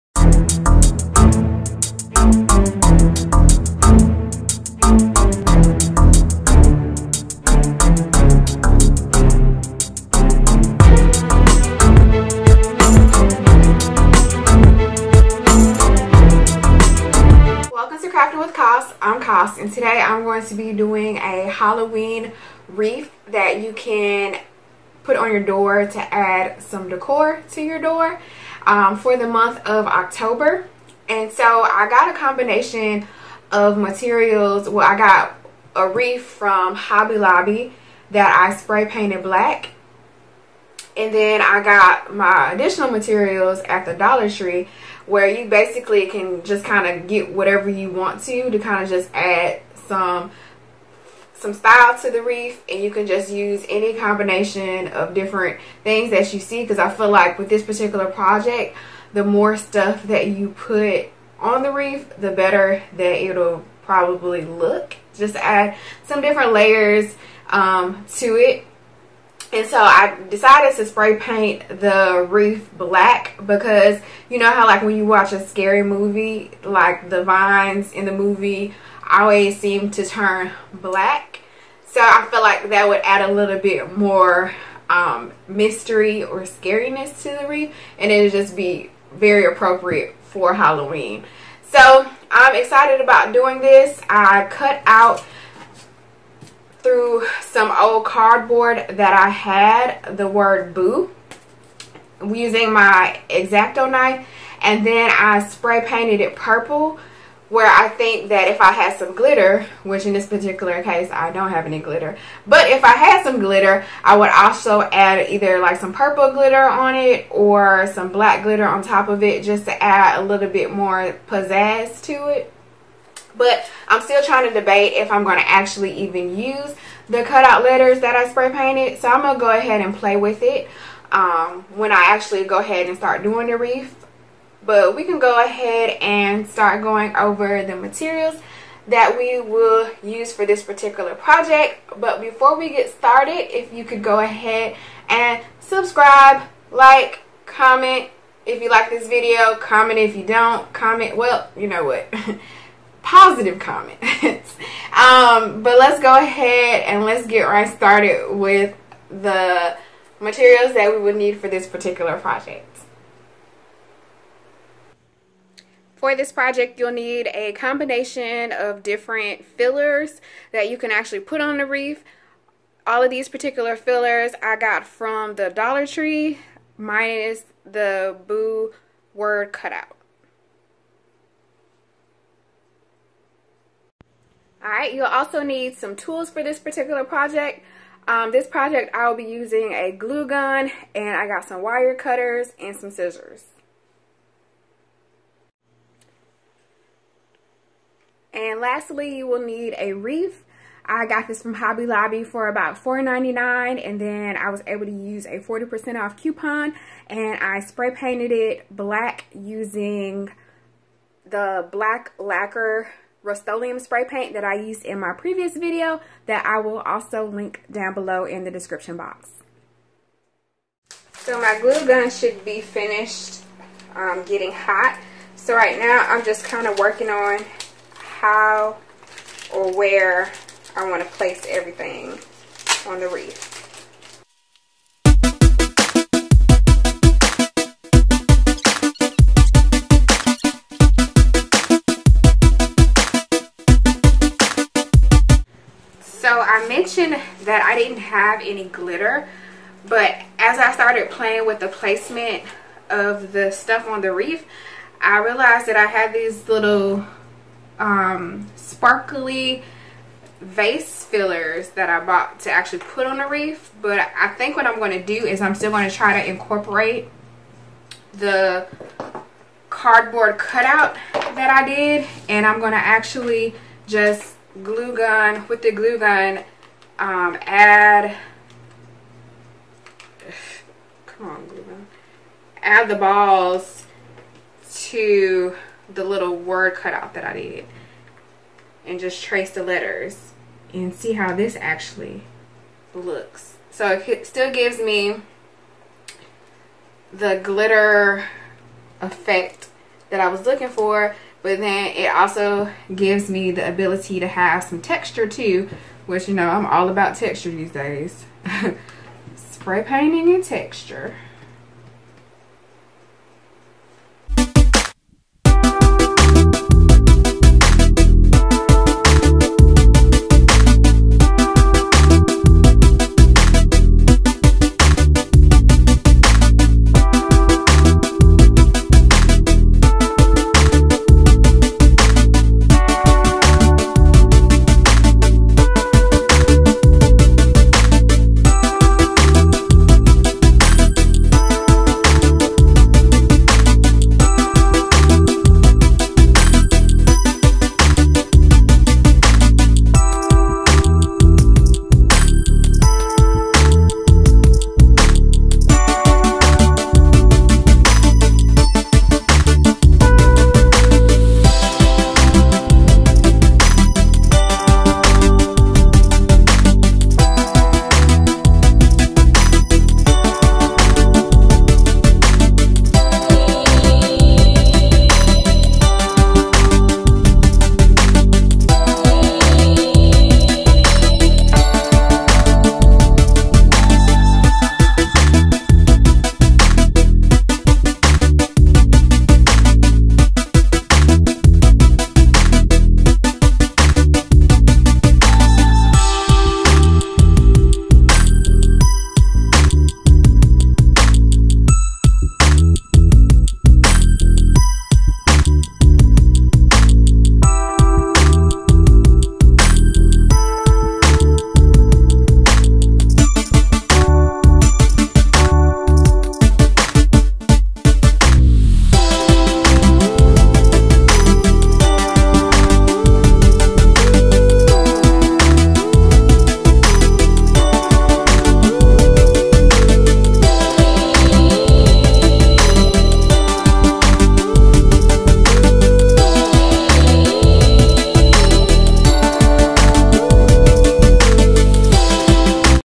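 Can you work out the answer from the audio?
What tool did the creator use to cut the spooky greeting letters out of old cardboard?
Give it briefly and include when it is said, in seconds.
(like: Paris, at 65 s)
X-Acto knife, at 103 s.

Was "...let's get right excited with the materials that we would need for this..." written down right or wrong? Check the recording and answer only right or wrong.
wrong.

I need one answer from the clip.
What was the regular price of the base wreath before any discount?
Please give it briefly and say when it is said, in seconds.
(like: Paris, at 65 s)
$4.99, at 202 s.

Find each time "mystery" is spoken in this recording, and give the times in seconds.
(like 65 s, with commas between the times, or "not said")
85 s.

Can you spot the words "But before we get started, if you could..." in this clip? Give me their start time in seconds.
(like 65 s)
141 s.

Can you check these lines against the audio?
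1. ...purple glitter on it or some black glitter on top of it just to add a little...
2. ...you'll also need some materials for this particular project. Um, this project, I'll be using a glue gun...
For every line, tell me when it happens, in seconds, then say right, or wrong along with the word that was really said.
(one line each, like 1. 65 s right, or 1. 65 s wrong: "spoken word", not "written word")
1. 115 s right
2. 184 s wrong: "tools", not "materials".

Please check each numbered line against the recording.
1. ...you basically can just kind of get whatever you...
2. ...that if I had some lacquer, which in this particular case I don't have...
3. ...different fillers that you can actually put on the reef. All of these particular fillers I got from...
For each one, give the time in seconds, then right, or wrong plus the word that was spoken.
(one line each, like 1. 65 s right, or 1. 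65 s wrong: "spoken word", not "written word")
1. 45 s right
2. 108 s wrong: "glitter", not "lacquer"
3. 168 s right.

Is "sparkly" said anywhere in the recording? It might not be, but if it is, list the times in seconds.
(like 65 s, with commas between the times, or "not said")
258 s.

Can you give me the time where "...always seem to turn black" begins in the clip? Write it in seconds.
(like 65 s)
79 s.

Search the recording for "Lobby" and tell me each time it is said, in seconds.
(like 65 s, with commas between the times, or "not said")
37 s, 201 s.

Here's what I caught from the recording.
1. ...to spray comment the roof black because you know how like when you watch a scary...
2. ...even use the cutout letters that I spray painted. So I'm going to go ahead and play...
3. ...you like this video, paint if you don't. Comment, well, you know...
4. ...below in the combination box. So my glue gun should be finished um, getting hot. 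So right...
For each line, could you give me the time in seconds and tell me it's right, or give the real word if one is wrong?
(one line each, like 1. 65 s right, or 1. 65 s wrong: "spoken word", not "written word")
1. 70 s wrong: "paint", not "comment"
2. 125 s right
3. 148 s wrong: "comment", not "paint"
4. 217 s wrong: "description", not "combination".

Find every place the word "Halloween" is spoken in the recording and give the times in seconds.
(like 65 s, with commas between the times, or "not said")
21 s, 90 s.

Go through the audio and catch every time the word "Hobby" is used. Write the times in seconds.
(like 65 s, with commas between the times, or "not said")
36 s, 201 s.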